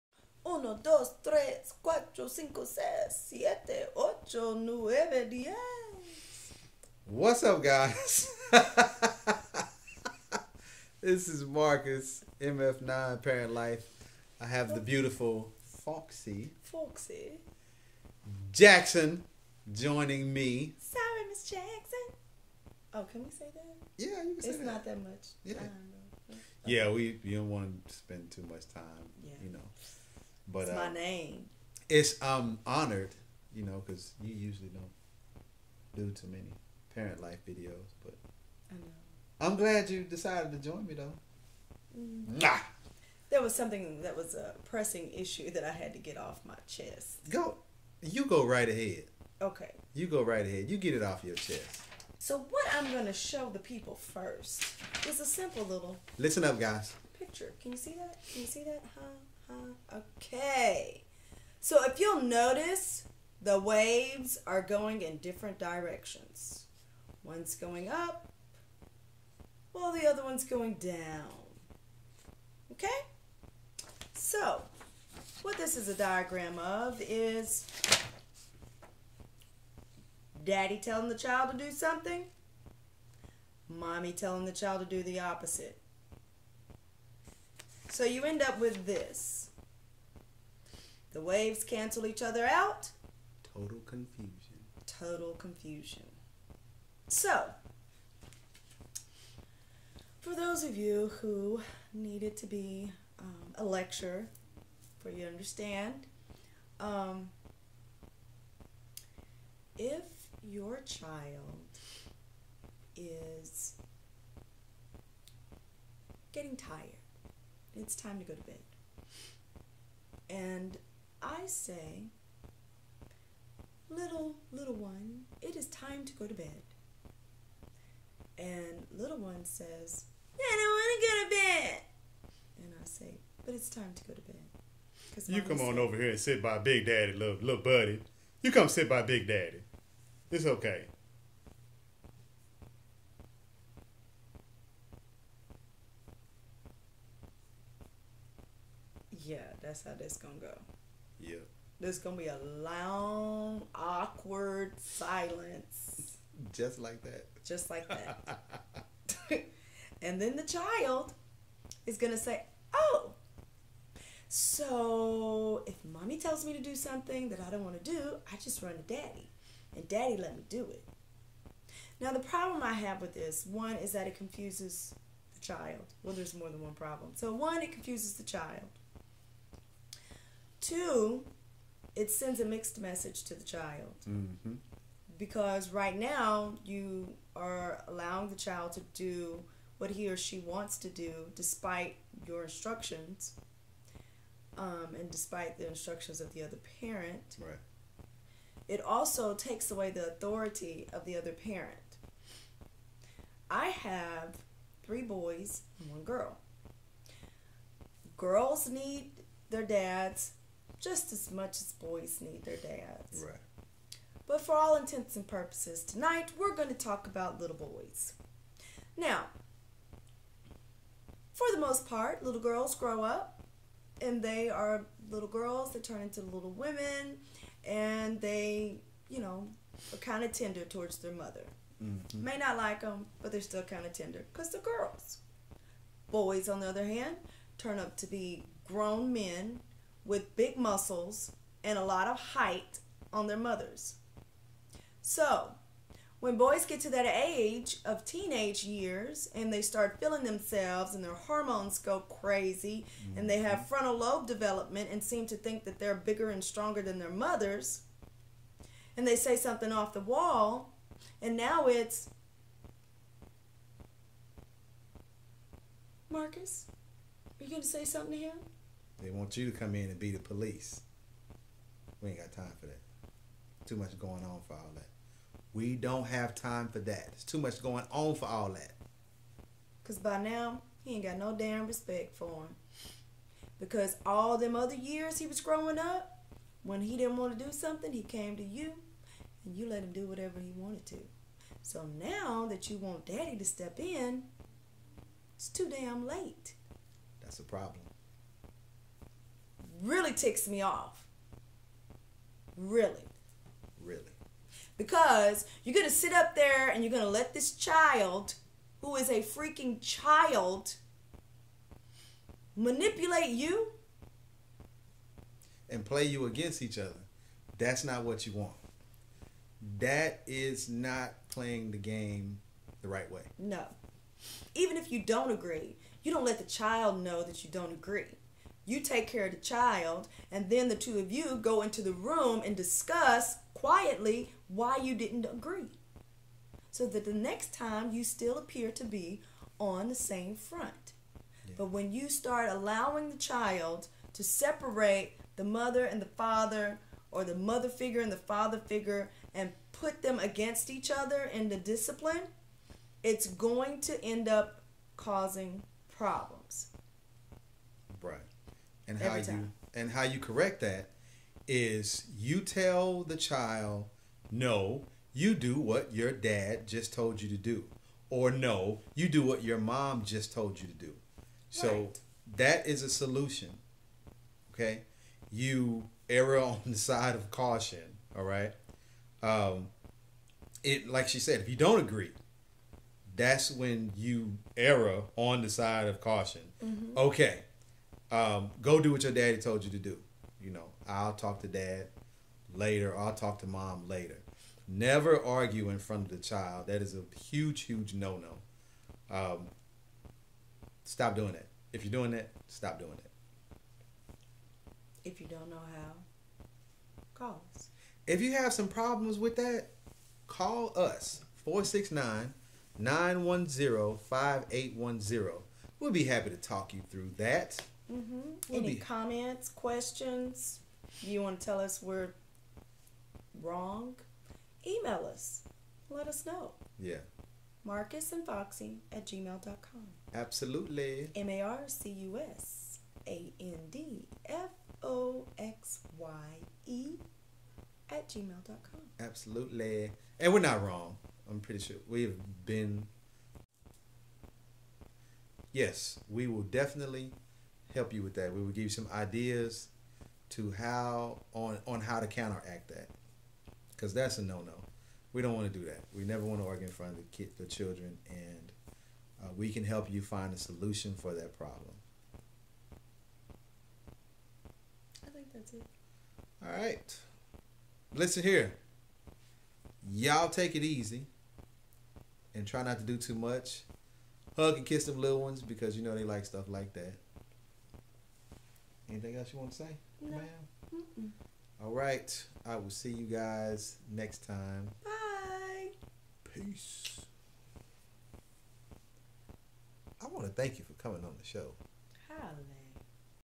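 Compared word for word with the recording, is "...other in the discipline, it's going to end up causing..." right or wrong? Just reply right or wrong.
right.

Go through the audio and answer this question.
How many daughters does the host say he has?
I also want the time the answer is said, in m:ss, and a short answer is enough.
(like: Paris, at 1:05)
1, at 3:25.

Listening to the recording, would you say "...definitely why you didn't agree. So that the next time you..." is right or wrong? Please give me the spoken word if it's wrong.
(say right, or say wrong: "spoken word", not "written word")
wrong: "quietly", not "definitely".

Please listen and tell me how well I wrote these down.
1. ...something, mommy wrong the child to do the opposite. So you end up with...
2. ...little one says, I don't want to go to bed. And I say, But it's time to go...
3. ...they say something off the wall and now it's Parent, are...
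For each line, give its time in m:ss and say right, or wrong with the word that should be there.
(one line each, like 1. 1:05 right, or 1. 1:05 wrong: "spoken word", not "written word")
1. 1:21 wrong: "telling", not "wrong"
2. 2:08 right
3. 4:19 wrong: "Marcus", not "Parent".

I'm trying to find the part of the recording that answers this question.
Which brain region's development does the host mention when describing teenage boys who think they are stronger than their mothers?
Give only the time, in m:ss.
4:13.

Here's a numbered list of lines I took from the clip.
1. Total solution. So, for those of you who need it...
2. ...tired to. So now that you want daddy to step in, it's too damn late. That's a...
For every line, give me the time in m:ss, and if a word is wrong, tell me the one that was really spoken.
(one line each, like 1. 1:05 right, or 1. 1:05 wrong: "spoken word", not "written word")
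1. 1:34 wrong: "confusion", not "solution"
2. 4:50 wrong: "wanted", not "tired".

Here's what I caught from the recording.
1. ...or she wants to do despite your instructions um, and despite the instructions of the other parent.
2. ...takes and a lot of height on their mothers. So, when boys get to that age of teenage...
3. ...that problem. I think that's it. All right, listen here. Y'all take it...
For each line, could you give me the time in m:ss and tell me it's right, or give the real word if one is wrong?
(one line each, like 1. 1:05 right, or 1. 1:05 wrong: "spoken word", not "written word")
1. 3:10 right
2. 4:00 wrong: "muscles", not "takes"
3. 7:41 right.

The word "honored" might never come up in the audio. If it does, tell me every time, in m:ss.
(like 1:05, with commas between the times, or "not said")
0:32.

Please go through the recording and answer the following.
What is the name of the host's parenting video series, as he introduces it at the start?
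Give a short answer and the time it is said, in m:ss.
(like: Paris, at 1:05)
MF9 Parent Life, at 0:12.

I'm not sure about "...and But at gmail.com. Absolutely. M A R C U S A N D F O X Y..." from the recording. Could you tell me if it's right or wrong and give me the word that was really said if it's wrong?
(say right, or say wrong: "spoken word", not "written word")
wrong: "Foxy", not "But".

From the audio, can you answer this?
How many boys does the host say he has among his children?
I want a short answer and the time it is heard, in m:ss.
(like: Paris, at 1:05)
3, at 3:24.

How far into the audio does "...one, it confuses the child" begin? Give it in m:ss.
2:57.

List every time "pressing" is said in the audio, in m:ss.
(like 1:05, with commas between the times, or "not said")
0:44.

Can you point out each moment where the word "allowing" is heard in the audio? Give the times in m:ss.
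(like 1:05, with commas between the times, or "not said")
3:07, 5:42.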